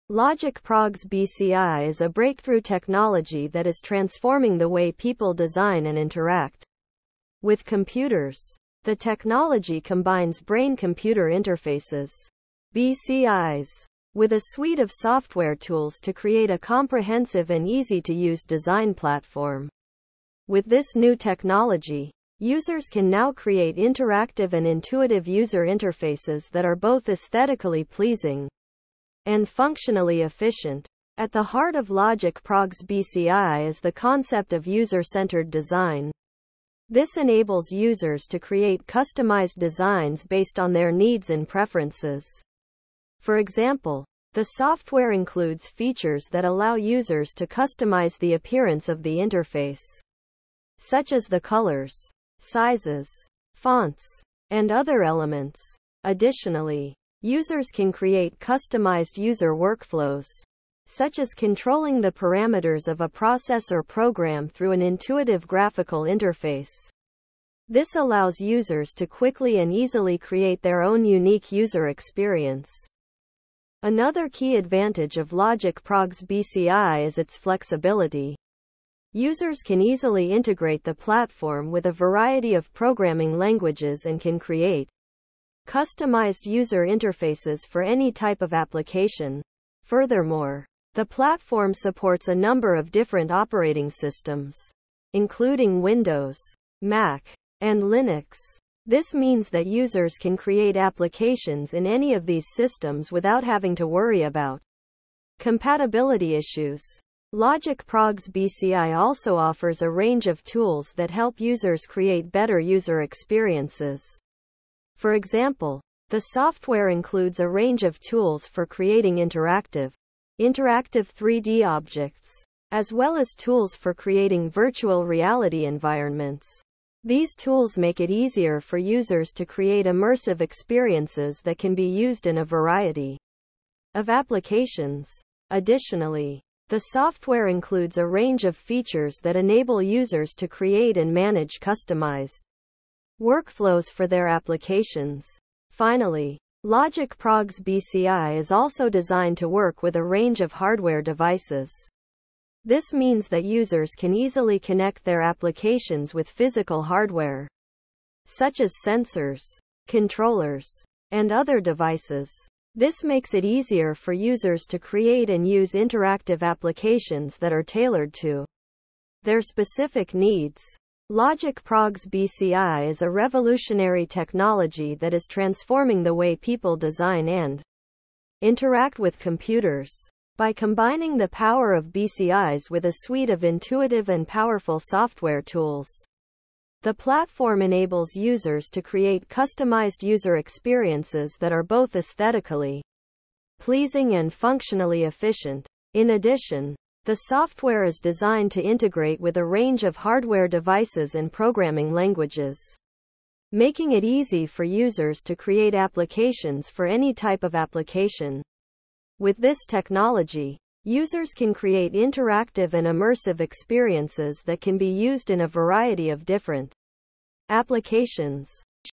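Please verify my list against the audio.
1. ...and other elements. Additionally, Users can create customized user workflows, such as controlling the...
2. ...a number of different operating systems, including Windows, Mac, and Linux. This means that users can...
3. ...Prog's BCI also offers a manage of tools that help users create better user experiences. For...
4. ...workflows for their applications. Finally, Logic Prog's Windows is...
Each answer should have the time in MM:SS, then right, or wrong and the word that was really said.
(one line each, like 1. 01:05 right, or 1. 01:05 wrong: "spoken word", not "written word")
1. 00:54 right
2. 01:32 right
3. 01:47 wrong: "range", not "manage"
4. 02:23 wrong: "BCI", not "Windows".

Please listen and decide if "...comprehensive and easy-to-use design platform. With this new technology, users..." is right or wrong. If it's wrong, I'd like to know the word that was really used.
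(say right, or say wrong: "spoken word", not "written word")
right.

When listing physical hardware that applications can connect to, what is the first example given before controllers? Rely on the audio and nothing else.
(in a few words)
Sensors.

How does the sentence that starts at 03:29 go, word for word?
With this technology, users can create interactive and immersive experiences that can be used in a variety of different applications.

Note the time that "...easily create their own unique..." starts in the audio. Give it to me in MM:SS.
01:09.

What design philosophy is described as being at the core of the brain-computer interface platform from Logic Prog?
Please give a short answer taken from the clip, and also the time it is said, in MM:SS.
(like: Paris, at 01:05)
User-centered design, at 00:34.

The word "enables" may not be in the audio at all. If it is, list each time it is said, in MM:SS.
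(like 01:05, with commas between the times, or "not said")
00:37, 02:19, 03:07.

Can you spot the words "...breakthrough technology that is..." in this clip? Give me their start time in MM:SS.
00:02.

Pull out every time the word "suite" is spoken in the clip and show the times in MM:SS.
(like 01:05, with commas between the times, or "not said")
00:14, 03:02.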